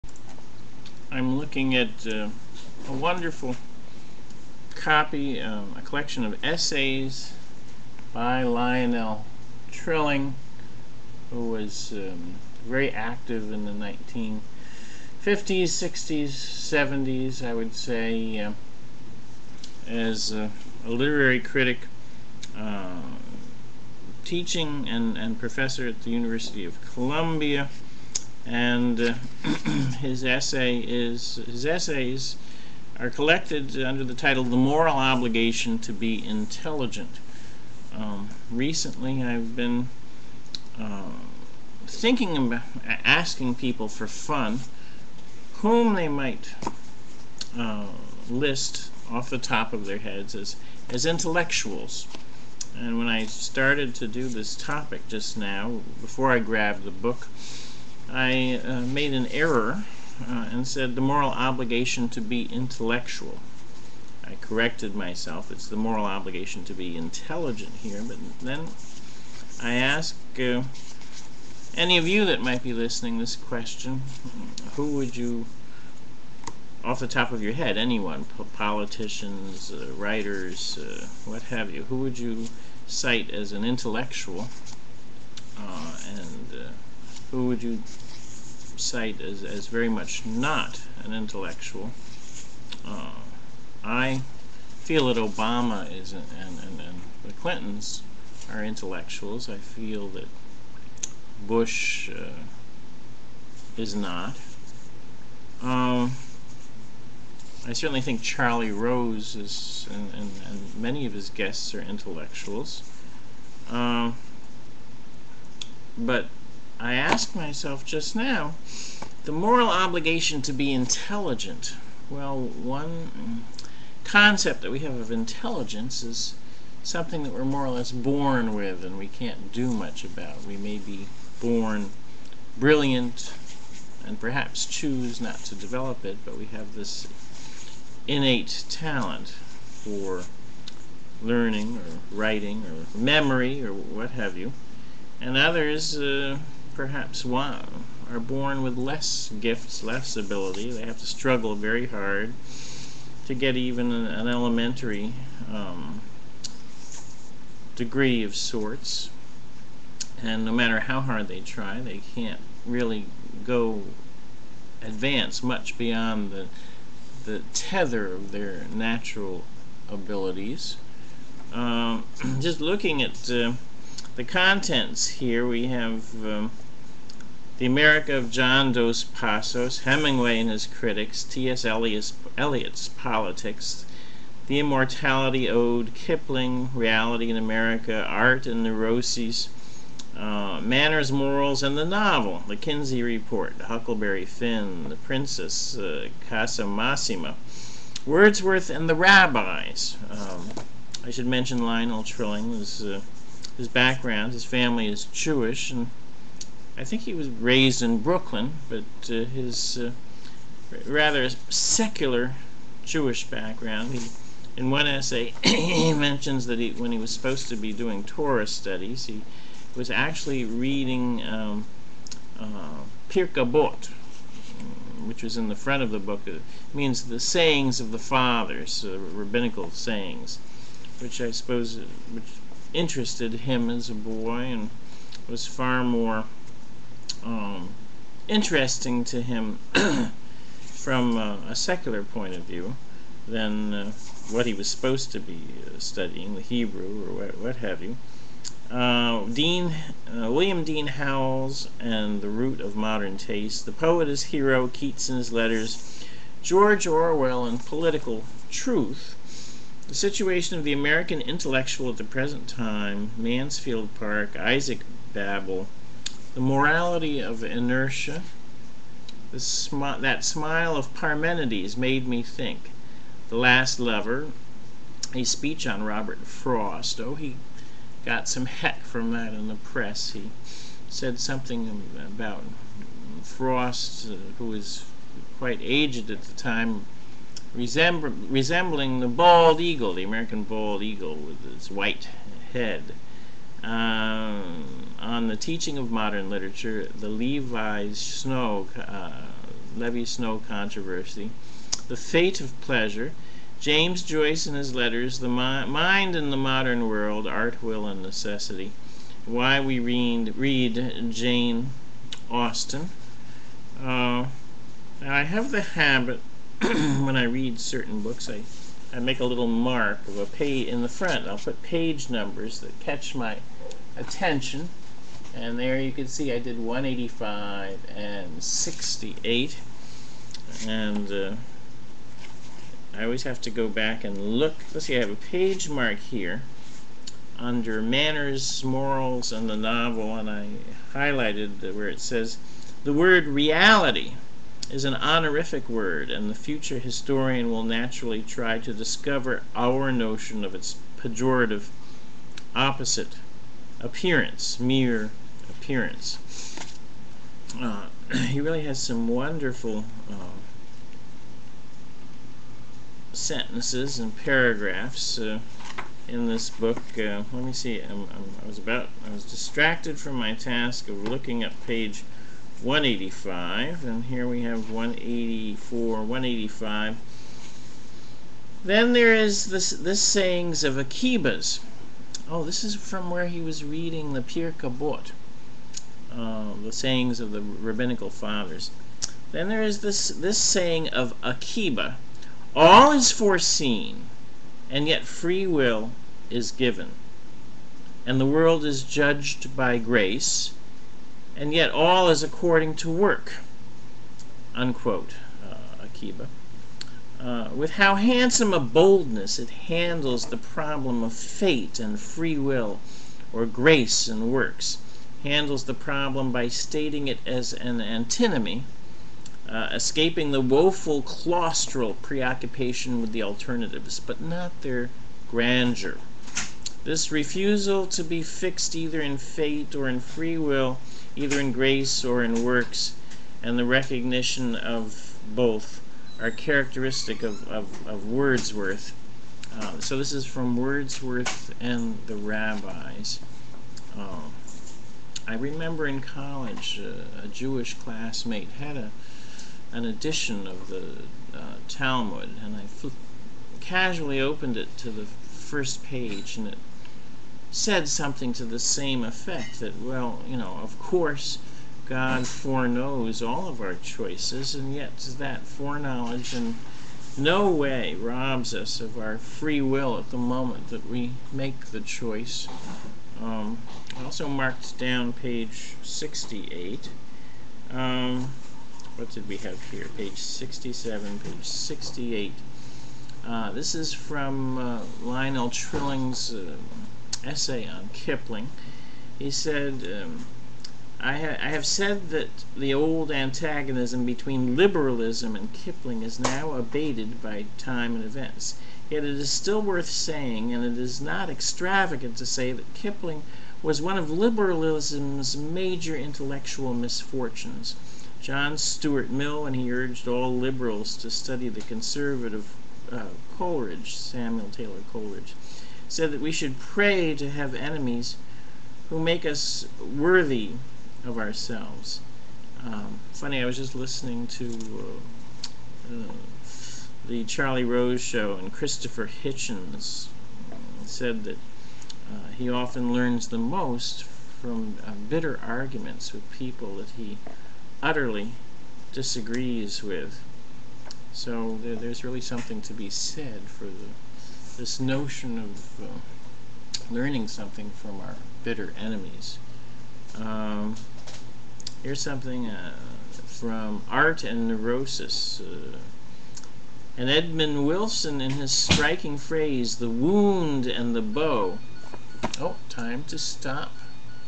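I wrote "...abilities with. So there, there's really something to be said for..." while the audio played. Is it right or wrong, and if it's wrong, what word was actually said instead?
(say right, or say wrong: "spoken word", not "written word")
wrong: "disagrees", not "abilities".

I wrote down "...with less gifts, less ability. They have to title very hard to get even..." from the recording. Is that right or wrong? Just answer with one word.
wrong.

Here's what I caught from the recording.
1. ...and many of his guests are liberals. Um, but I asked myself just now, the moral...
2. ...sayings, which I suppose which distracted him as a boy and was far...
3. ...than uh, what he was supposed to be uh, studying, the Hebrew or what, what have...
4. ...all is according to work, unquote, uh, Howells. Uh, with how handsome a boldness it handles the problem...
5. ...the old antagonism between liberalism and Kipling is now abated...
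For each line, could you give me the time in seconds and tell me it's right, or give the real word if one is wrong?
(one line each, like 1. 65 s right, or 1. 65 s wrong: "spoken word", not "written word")
1. 110 s wrong: "intellectuals", not "liberals"
2. 229 s wrong: "interested", not "distracted"
3. 243 s right
4. 401 s wrong: "Akiba", not "Howells"
5. 492 s right.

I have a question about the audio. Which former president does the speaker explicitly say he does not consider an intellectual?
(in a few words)
Bush.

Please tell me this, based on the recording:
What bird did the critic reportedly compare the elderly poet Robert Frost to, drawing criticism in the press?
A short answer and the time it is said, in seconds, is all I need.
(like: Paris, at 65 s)
American bald eagle, at 290 s.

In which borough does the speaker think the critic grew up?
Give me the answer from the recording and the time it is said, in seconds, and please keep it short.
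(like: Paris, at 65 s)
Brooklyn, at 207 s.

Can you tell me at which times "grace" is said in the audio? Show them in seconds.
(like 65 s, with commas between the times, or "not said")
399 s, 413 s, 431 s.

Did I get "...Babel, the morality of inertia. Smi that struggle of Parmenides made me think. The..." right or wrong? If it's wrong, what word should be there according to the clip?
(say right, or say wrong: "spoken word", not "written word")
wrong: "smile", not "struggle".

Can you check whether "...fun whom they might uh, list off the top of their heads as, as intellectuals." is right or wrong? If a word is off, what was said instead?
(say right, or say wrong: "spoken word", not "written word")
right.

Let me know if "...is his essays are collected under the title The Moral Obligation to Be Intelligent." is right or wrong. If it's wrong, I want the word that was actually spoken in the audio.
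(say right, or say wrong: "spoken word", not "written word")
right.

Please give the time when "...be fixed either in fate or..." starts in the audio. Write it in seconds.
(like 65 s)
428 s.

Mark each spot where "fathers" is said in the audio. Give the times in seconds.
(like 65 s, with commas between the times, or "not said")
227 s, 388 s.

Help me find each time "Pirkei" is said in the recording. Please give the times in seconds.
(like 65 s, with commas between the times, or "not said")
223 s, 384 s.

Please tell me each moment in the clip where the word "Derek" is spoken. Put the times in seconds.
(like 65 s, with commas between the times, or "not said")
not said.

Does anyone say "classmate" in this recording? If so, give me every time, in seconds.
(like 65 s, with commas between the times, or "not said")
447 s.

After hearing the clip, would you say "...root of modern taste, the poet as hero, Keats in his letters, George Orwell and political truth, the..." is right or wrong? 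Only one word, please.
right.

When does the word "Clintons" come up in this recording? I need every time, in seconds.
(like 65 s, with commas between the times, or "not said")
97 s.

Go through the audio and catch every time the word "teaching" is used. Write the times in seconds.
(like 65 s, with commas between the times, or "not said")
24 s, 295 s.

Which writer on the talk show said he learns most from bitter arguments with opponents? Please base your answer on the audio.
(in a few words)
Christopher Hitchens.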